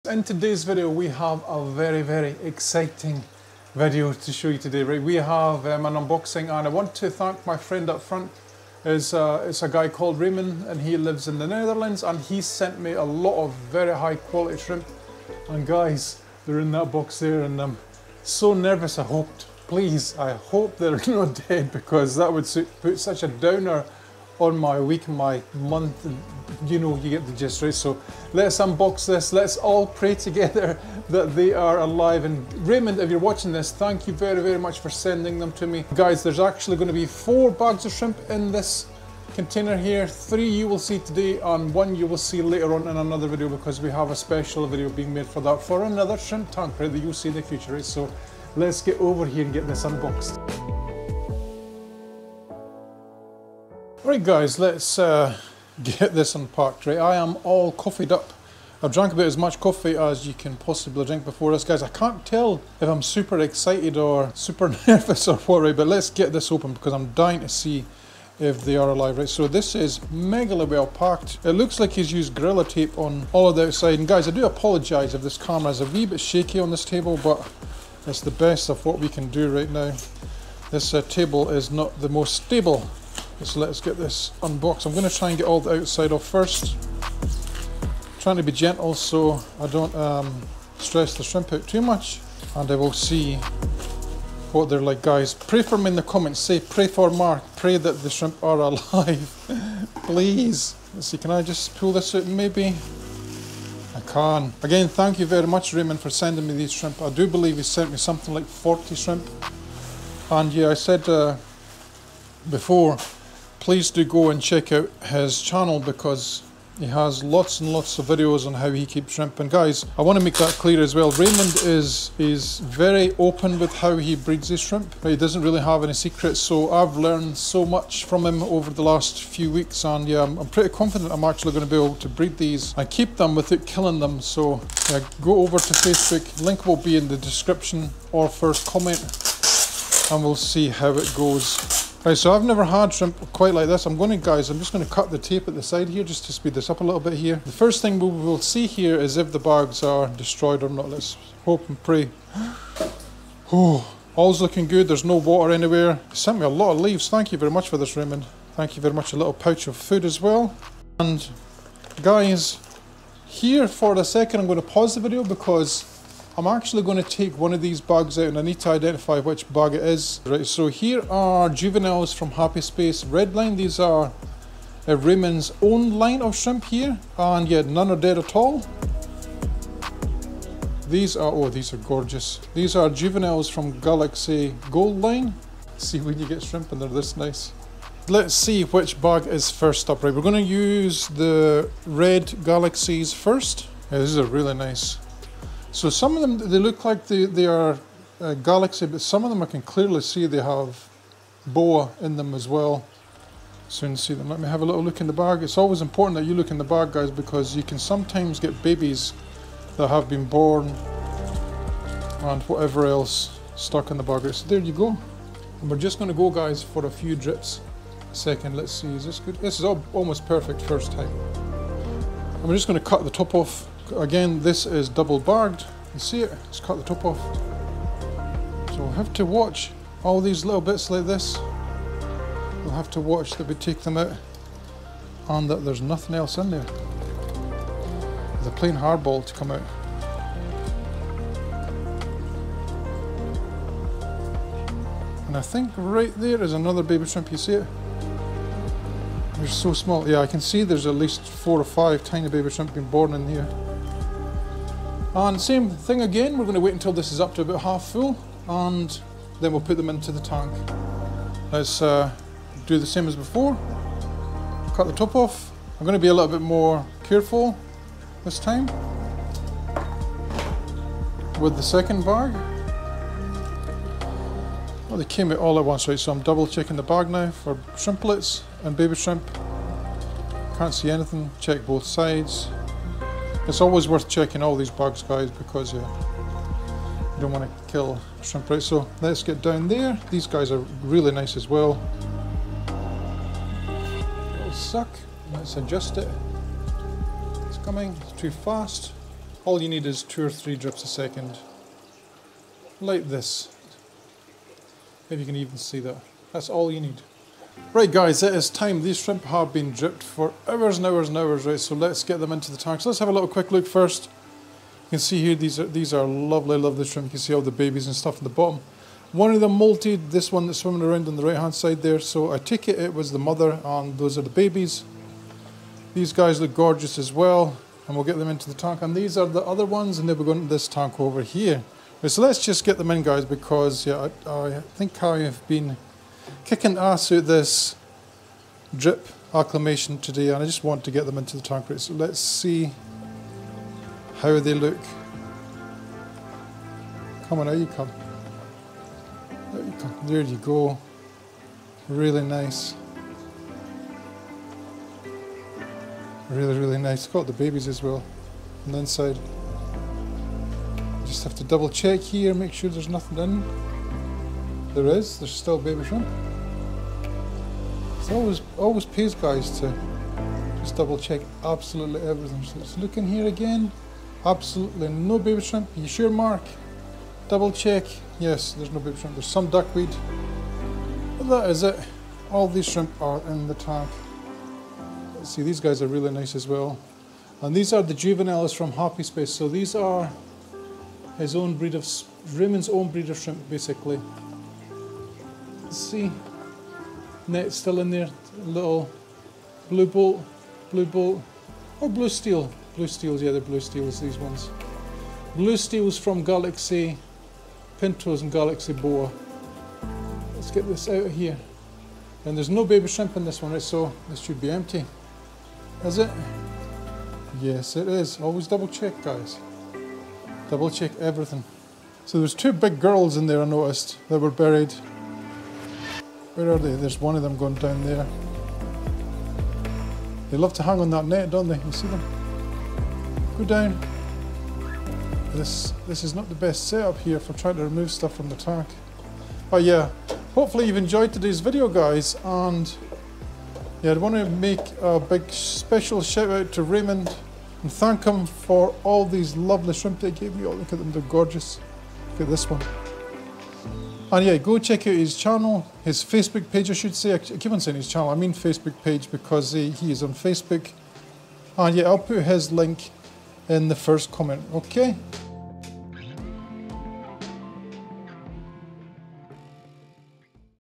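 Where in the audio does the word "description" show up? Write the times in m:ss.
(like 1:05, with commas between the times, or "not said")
2:17.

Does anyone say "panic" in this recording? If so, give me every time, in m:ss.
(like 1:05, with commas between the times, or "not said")
not said.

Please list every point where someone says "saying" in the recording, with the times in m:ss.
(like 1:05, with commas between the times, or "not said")
7:37.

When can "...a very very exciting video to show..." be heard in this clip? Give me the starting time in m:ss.
0:01.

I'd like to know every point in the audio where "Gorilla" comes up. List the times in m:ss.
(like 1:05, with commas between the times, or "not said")
1:12.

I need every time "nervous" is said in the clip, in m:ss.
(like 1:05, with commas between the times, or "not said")
0:18, 1:04.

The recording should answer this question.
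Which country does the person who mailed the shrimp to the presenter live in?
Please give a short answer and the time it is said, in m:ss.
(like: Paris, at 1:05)
Netherlands, at 0:11.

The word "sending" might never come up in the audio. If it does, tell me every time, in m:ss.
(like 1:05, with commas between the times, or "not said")
0:34, 1:46.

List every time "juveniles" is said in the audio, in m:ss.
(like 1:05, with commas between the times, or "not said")
2:51, 3:02, 6:27.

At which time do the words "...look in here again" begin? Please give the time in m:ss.
6:12.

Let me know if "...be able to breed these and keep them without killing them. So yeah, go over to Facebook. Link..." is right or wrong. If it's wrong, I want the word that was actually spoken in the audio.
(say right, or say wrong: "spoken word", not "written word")
right.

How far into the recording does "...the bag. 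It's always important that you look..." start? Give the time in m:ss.
3:25.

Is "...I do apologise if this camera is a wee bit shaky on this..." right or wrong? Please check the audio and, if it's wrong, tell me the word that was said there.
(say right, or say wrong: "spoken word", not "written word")
right.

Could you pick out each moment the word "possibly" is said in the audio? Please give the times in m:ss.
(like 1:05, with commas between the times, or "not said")
1:00.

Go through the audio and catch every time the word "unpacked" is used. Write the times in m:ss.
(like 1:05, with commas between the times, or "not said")
0:56.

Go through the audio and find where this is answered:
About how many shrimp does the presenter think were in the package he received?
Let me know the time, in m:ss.
1:48.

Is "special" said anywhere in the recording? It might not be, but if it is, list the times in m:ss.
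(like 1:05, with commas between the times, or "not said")
0:44, 7:25.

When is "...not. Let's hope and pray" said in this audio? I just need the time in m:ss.
2:30.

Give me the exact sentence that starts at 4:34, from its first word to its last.
Well, they came out all at once, right?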